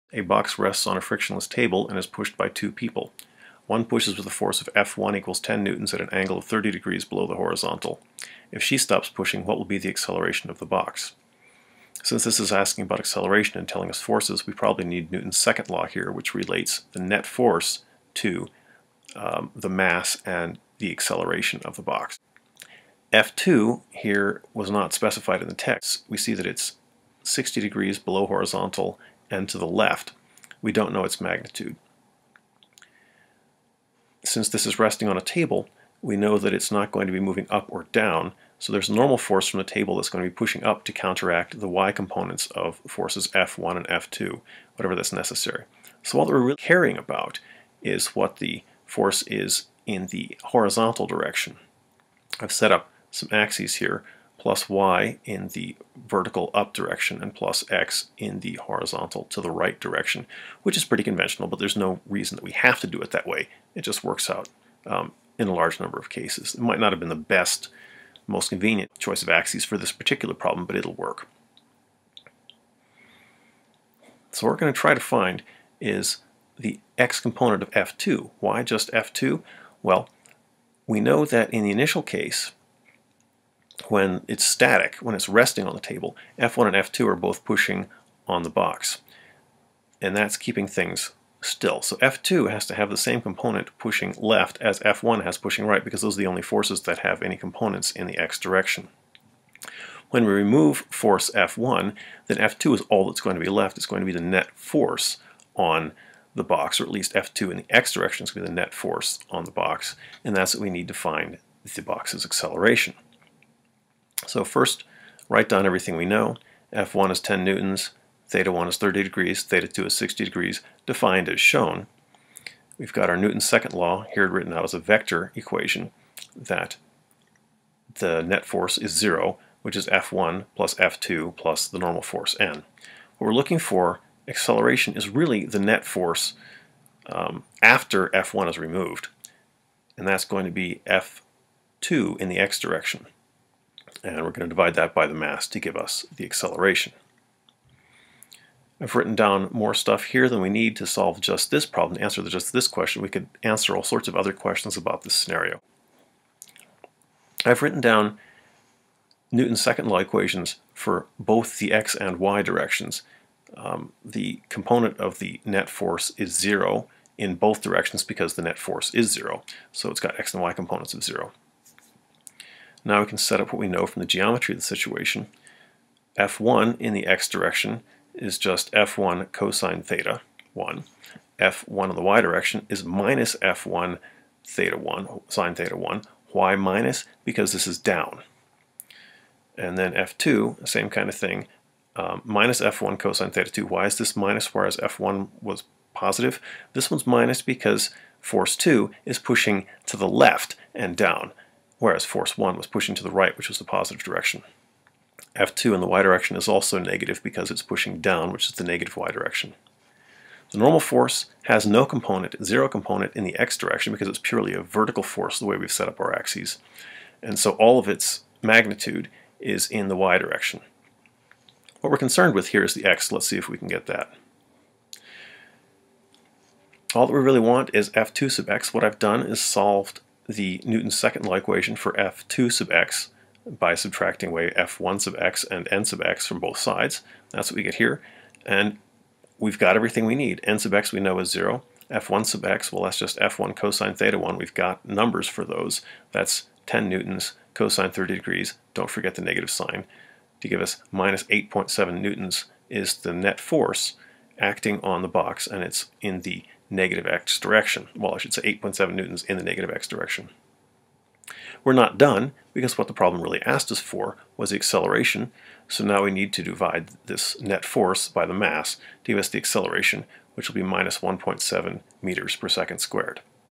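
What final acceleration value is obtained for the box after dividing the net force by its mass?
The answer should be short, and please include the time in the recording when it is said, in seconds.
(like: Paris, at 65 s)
-1.7 m/s^2, at 270 s.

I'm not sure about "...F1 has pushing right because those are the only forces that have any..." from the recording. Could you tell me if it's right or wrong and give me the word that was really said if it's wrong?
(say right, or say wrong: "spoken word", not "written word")
right.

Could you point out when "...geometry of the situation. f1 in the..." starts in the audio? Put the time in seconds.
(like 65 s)
174 s.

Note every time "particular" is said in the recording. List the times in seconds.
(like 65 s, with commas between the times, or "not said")
69 s.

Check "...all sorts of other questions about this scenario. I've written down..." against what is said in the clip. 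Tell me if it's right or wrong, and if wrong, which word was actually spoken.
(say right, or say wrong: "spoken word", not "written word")
right.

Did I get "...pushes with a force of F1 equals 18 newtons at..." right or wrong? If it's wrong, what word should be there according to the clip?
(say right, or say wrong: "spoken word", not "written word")
wrong: "10", not "18".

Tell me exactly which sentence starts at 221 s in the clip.
What we're concerned with here is the x.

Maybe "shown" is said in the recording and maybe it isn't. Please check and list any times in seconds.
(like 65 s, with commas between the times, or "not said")
121 s.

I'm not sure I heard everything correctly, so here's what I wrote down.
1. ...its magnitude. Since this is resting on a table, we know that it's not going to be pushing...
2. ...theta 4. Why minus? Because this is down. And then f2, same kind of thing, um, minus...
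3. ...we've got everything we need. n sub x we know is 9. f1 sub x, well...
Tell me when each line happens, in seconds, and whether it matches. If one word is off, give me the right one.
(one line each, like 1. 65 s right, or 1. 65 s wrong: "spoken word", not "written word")
1. 31 s wrong: "moving", not "pushing"
2. 185 s wrong: "1", not "4"
3. 239 s wrong: "0", not "9".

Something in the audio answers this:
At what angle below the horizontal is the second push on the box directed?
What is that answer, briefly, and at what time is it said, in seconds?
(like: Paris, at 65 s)
60 degrees, at 27 s.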